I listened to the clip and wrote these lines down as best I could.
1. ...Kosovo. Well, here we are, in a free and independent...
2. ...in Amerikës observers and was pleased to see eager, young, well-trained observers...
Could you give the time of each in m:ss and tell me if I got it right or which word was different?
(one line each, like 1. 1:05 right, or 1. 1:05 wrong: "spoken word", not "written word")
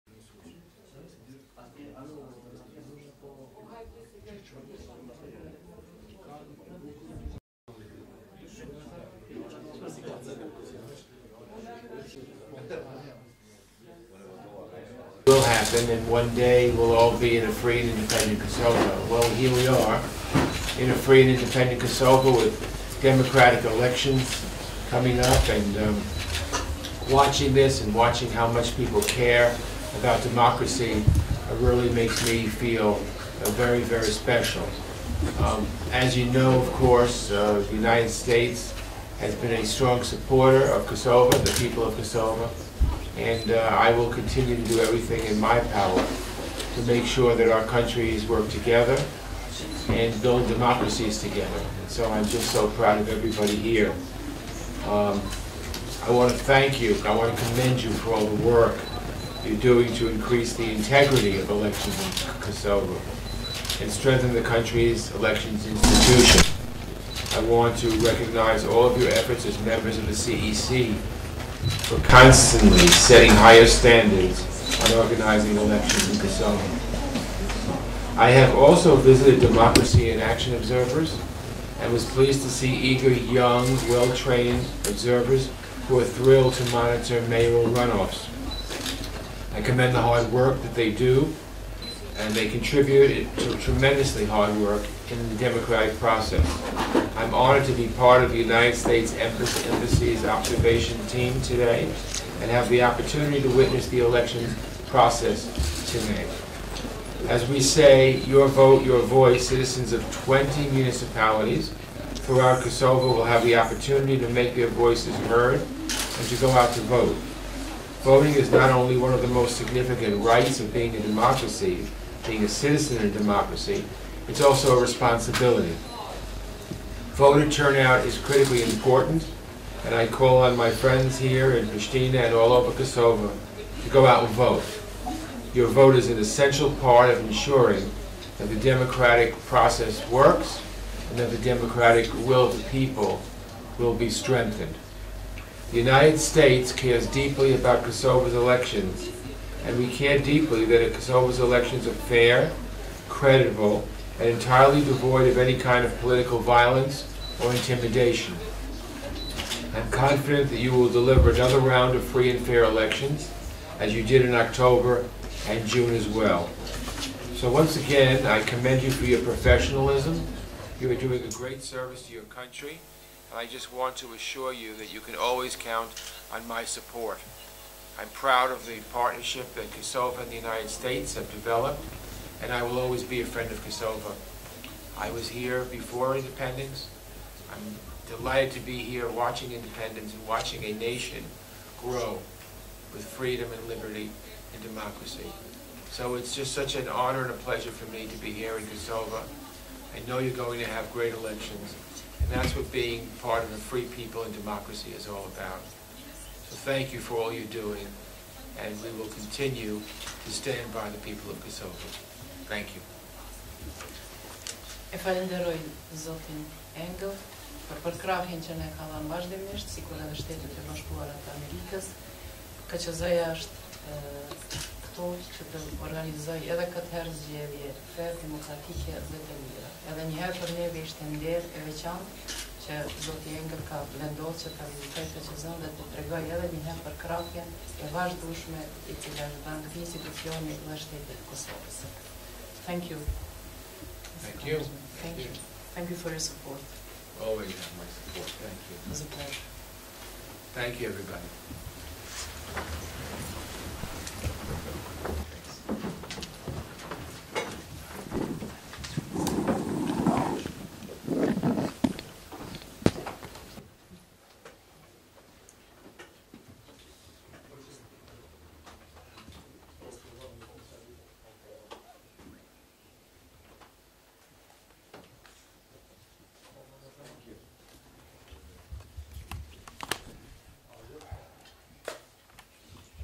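1. 0:18 right
2. 1:20 wrong: "Action", not "Amerikës".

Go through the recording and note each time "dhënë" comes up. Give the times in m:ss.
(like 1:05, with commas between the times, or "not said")
3:38, 3:59.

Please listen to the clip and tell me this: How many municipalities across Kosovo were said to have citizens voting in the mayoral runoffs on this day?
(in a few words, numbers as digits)
20.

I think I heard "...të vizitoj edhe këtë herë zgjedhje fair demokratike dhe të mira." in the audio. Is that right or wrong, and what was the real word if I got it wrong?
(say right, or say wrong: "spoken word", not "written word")
wrong: "organizoj", not "vizitoj".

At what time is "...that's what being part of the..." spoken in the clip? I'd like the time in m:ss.
3:22.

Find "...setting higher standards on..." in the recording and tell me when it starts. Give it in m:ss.
1:12.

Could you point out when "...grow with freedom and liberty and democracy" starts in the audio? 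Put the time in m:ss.
3:11.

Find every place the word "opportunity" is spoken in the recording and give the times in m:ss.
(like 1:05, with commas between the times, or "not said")
1:42, 1:53.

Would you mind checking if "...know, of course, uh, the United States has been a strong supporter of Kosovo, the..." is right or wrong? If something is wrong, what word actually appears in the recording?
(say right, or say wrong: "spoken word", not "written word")
right.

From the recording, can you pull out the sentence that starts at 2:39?
I'm confident that you will deliver another round of free and fair elections, as you did in October and June as well.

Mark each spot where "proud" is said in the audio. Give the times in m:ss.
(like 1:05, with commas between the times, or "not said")
0:52, 2:58.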